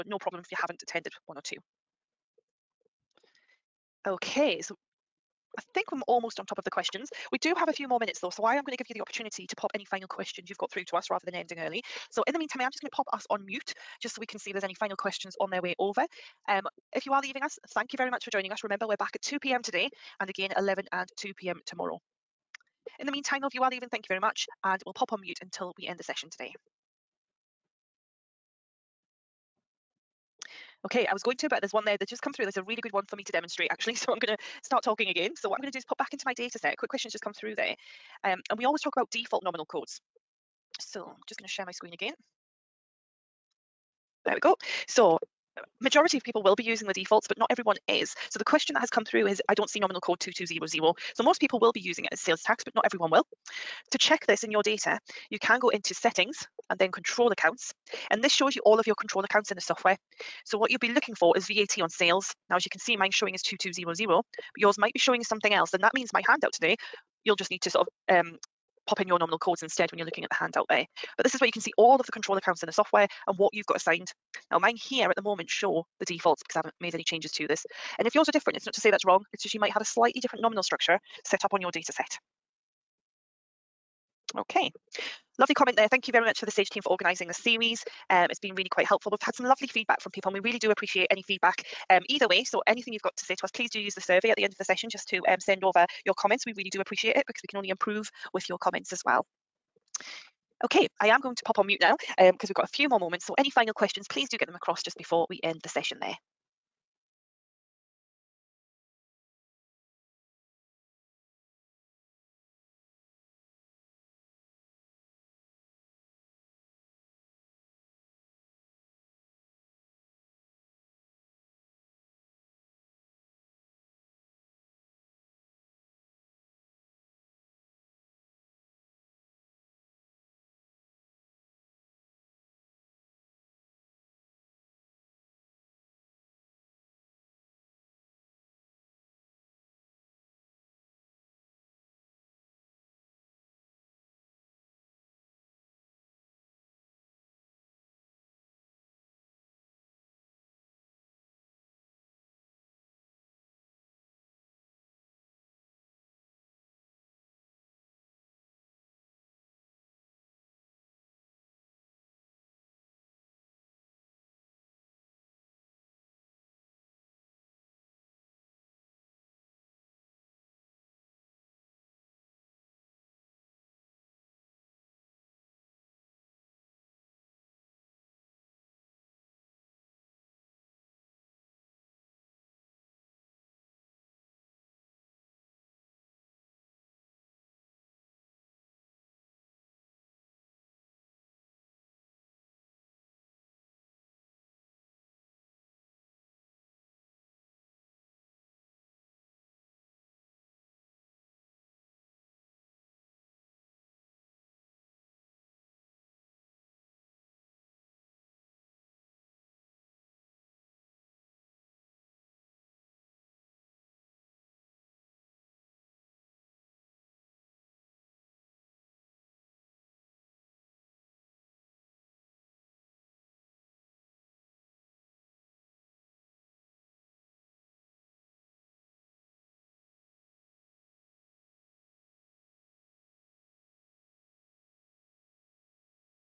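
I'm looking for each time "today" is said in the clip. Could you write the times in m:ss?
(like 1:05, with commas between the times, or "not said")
0:19, 0:26, 1:06.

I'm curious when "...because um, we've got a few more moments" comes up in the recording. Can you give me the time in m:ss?
1:42.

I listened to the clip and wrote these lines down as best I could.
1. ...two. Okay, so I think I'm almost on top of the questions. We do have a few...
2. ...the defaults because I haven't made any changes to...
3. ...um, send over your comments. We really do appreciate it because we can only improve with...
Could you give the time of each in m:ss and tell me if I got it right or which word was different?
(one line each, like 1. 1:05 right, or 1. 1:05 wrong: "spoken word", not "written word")
1. 0:01 right
2. 1:15 right
3. 1:35 right.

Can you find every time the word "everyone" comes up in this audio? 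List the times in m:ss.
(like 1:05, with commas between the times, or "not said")
0:47, 0:52.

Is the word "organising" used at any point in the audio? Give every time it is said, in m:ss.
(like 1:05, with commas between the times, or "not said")
1:26.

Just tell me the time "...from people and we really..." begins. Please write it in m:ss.
1:30.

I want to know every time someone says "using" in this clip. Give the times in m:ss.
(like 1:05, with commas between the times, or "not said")
0:46, 0:51.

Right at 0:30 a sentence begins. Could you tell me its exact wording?
Okay, I was going to, but there's one there that just come through.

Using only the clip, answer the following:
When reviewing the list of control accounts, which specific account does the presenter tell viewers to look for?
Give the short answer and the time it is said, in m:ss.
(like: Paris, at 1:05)
VAT on sales, at 1:01.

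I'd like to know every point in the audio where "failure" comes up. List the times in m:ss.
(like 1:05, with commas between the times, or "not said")
not said.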